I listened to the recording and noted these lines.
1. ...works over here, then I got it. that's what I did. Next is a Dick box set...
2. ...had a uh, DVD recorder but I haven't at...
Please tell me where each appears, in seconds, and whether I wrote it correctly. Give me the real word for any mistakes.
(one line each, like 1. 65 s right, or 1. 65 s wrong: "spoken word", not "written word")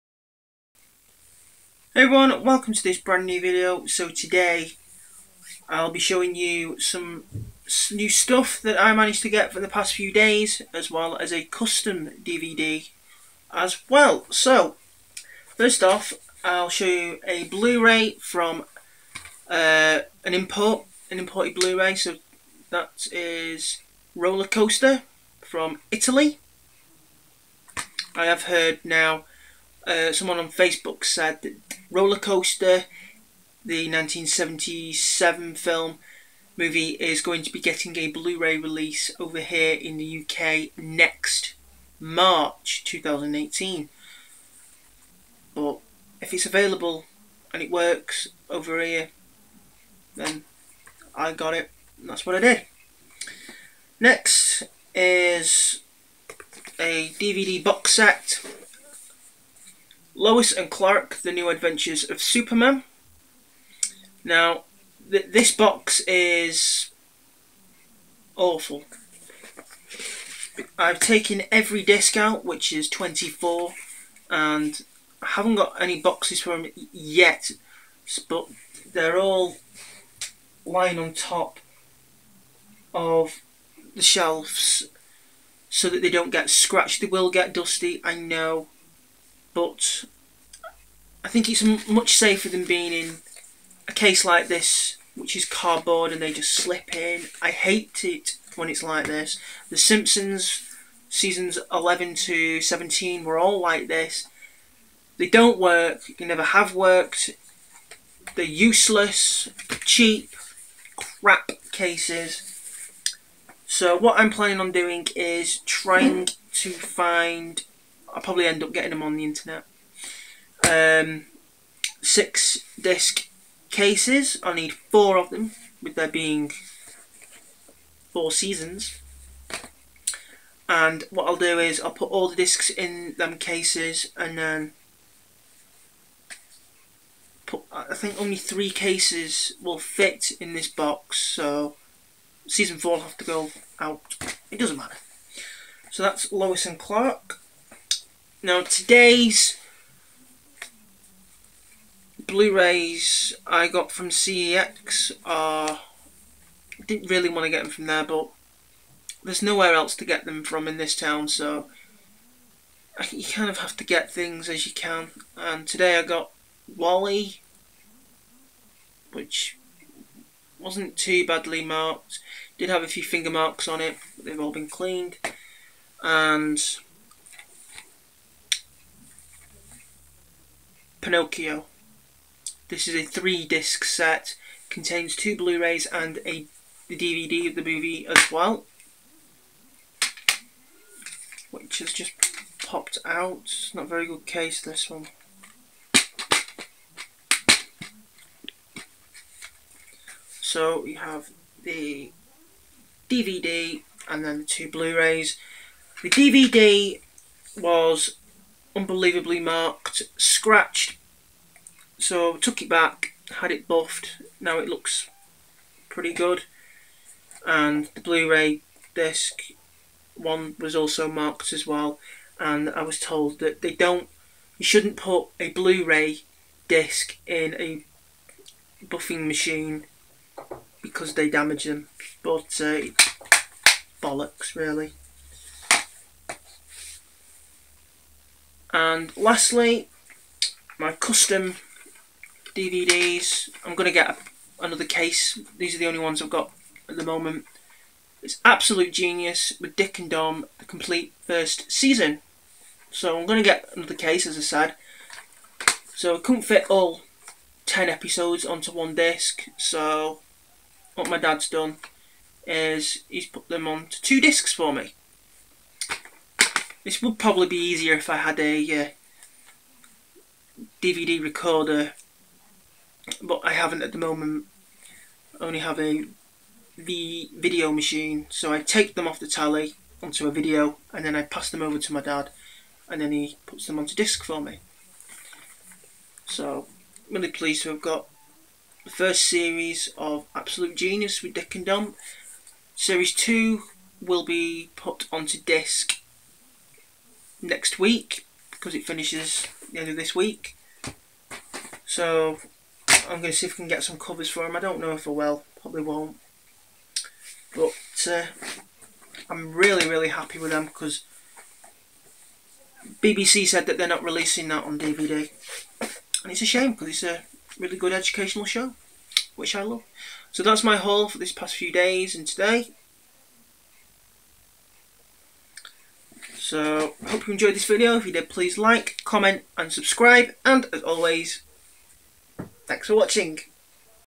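1. 47 s wrong: "DVD", not "Dick"
2. 268 s right.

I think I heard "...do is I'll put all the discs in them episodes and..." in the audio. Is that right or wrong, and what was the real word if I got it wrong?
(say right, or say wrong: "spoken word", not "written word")
wrong: "cases", not "episodes".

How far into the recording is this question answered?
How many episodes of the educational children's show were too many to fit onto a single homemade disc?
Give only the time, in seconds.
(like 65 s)
257 s.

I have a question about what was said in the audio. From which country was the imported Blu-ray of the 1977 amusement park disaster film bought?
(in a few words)
Italy.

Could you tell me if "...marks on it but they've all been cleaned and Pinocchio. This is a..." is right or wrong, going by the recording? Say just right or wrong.
right.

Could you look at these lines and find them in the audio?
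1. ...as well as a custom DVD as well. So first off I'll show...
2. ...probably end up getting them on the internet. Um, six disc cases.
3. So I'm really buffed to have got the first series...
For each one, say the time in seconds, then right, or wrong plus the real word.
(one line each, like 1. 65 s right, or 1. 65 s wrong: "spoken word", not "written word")
1. 10 s right
2. 118 s right
3. 286 s wrong: "pleased", not "buffed".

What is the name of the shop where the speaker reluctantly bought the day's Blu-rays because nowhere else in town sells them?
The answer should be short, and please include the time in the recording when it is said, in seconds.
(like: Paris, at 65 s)
CEX, at 154 s.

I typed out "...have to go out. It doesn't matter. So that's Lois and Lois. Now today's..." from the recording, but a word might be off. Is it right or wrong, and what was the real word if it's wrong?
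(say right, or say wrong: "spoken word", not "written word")
wrong: "Clark", not "Lois".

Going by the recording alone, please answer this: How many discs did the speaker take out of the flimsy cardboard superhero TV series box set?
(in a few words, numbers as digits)
24.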